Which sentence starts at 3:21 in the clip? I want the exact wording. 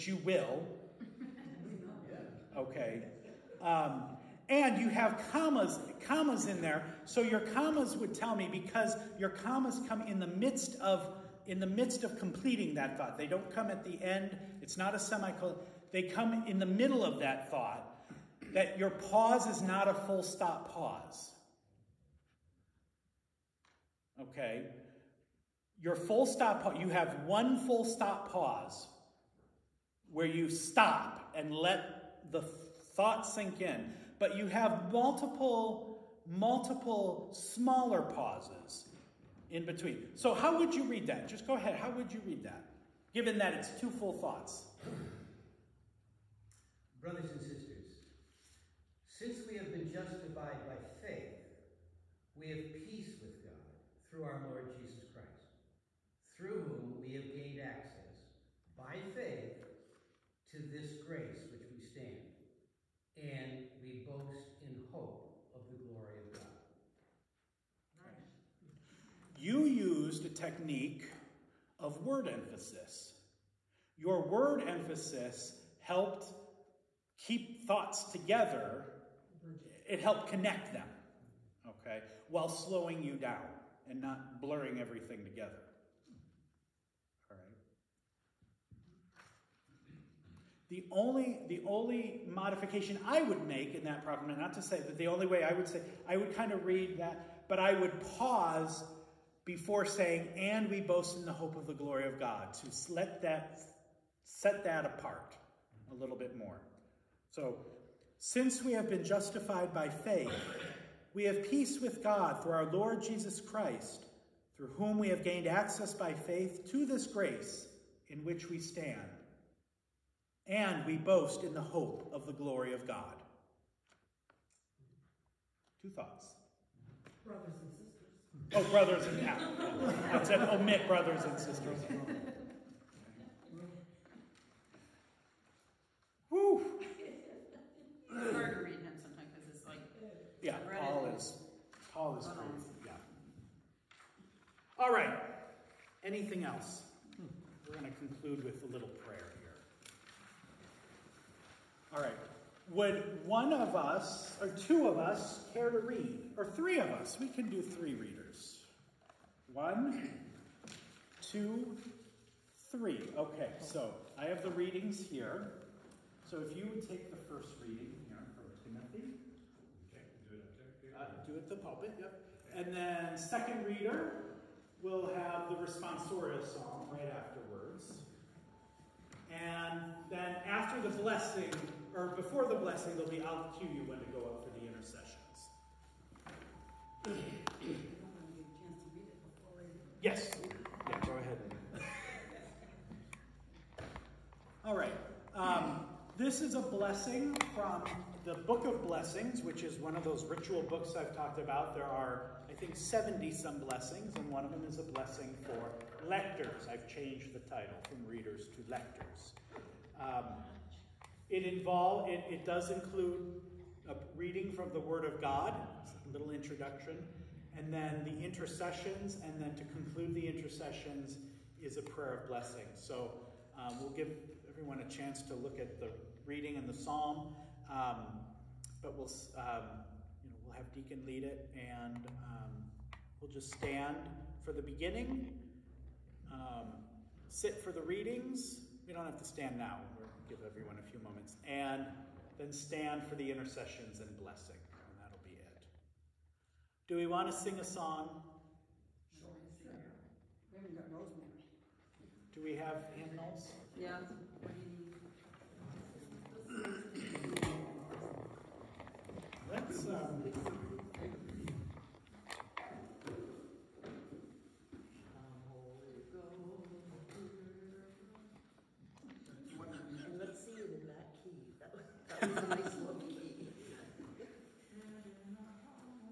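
There are, I think, 70 some blessings, and one of them is a blessing for lectors.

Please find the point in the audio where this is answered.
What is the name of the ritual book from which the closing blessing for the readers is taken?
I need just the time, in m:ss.
3:18.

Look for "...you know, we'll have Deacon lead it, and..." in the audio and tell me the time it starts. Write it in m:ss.
3:50.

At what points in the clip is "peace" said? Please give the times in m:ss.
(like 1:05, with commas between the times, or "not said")
0:52, 1:51.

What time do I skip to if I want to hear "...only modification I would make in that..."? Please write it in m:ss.
1:31.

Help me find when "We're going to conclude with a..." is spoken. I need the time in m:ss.
2:27.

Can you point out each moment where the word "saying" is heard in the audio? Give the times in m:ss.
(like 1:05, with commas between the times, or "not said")
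1:39.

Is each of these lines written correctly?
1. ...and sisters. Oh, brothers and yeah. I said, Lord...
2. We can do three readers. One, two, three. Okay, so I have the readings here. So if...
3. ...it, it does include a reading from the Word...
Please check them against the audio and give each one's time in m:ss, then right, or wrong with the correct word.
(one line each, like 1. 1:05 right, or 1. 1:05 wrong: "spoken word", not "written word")
1. 2:07 wrong: "Omit", not "Lord"
2. 2:37 right
3. 3:32 right.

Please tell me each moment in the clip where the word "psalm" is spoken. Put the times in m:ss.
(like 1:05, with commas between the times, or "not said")
2:56, 3:46.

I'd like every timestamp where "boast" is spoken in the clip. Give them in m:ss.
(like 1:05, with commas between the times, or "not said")
1:04, 1:40, 2:00.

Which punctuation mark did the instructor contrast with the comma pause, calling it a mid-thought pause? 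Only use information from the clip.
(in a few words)
semicolon.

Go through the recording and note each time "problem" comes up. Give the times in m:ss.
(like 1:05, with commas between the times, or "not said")
1:34.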